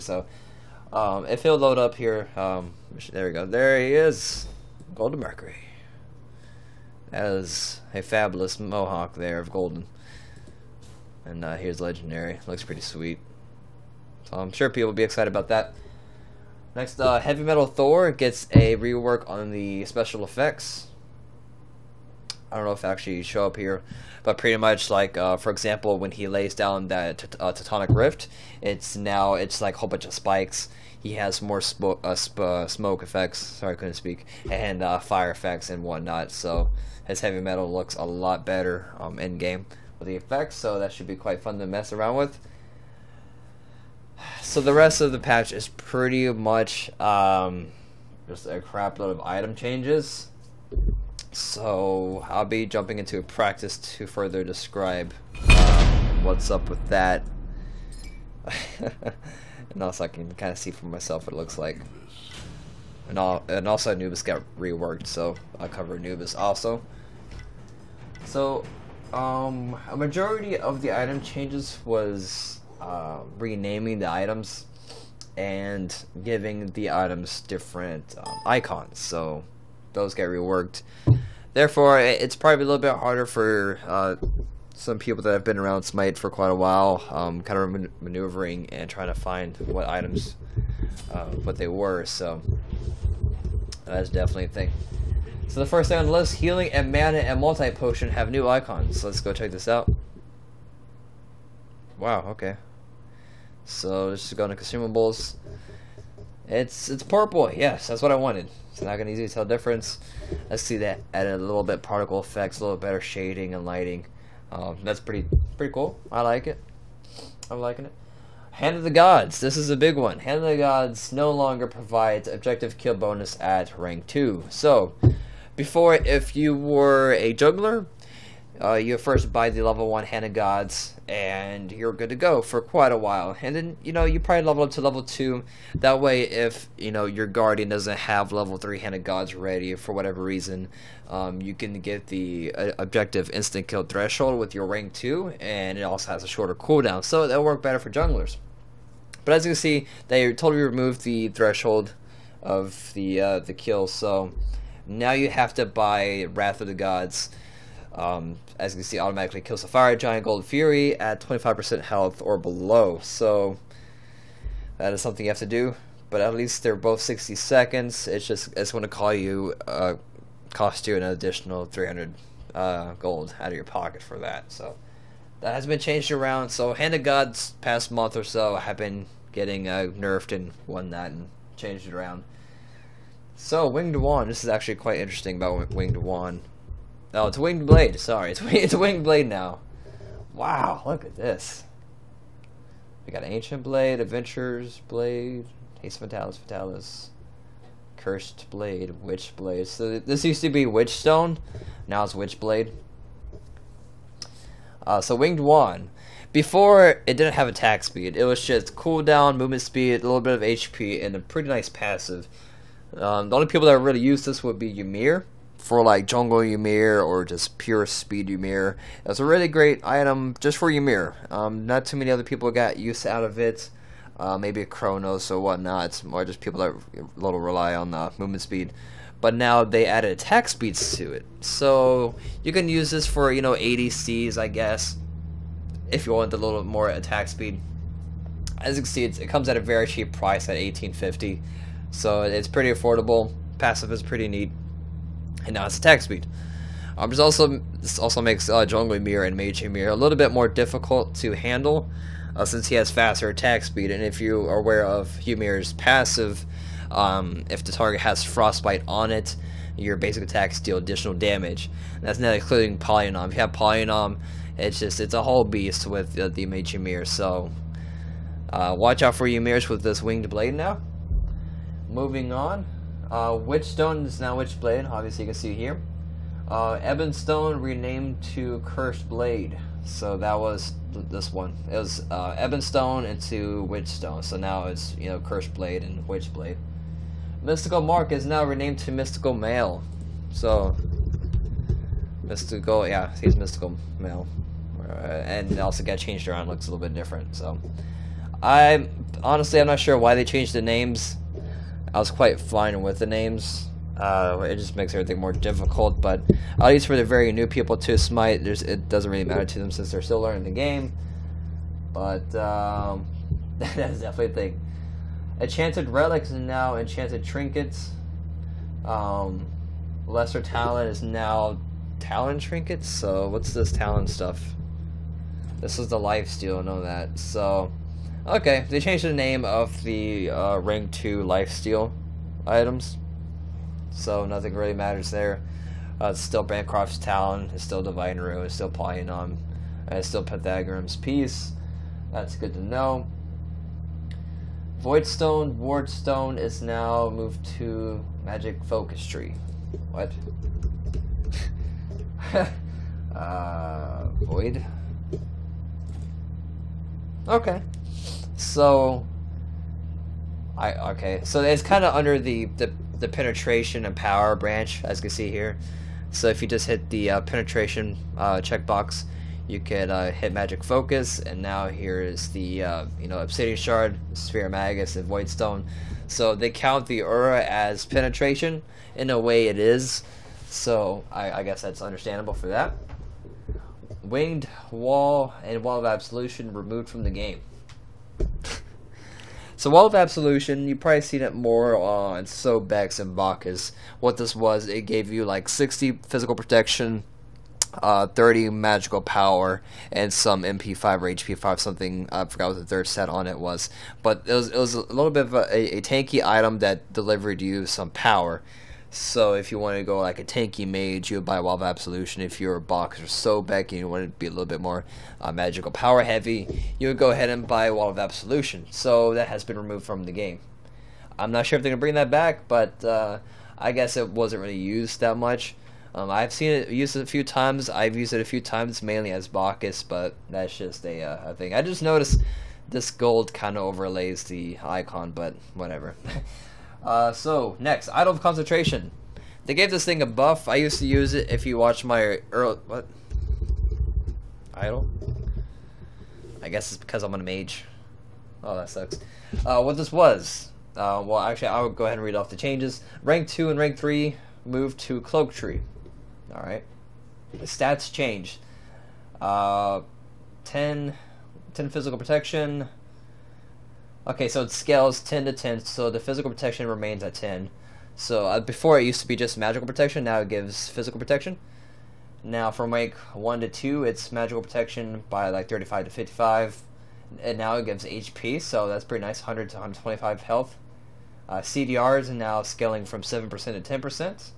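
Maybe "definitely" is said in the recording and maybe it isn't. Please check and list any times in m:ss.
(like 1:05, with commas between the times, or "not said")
1:34, 5:13.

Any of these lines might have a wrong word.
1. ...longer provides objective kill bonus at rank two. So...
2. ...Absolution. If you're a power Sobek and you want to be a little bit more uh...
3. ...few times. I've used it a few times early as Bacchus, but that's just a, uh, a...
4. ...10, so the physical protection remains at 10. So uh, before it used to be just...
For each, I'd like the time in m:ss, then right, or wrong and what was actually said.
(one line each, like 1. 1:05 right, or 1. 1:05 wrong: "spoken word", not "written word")
1. 2:01 right
2. 6:51 wrong: "boxer", not "power"
3. 7:07 wrong: "mainly", not "early"
4. 7:45 right.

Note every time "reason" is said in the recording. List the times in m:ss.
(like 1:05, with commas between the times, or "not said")
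2:20.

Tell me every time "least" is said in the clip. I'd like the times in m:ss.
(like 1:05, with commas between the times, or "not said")
2:46, 5:06.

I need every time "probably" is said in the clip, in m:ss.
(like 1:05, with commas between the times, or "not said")
1:22, 2:14, 6:30.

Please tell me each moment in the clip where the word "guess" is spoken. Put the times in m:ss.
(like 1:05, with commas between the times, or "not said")
3:54, 6:21, 7:03, 7:26.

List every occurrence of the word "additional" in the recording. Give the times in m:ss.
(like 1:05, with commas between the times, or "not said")
2:51, 4:20.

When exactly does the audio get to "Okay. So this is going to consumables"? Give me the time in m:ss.
1:42.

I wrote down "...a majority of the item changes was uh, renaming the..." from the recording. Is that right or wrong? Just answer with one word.
right.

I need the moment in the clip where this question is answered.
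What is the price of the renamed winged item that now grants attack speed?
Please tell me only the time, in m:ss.
4:00.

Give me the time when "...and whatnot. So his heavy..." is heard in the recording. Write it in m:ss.
0:35.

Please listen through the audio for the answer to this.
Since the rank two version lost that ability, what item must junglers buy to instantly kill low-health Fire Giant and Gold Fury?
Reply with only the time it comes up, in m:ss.
2:36.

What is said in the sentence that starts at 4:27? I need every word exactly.
So uh, watch out for Ymir's with this Winged Blade now.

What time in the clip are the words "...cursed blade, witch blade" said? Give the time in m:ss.
3:17.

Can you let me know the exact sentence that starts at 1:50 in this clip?
Let's see that added a little bit particle effects, a little better shading and lighting.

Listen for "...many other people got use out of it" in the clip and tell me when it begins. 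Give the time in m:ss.
3:41.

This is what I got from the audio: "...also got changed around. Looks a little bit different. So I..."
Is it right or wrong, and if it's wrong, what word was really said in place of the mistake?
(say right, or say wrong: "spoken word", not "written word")
right.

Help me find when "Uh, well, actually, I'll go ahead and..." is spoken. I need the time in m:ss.
7:30.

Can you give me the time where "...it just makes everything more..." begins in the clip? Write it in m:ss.
5:04.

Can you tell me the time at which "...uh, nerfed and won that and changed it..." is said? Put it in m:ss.
2:59.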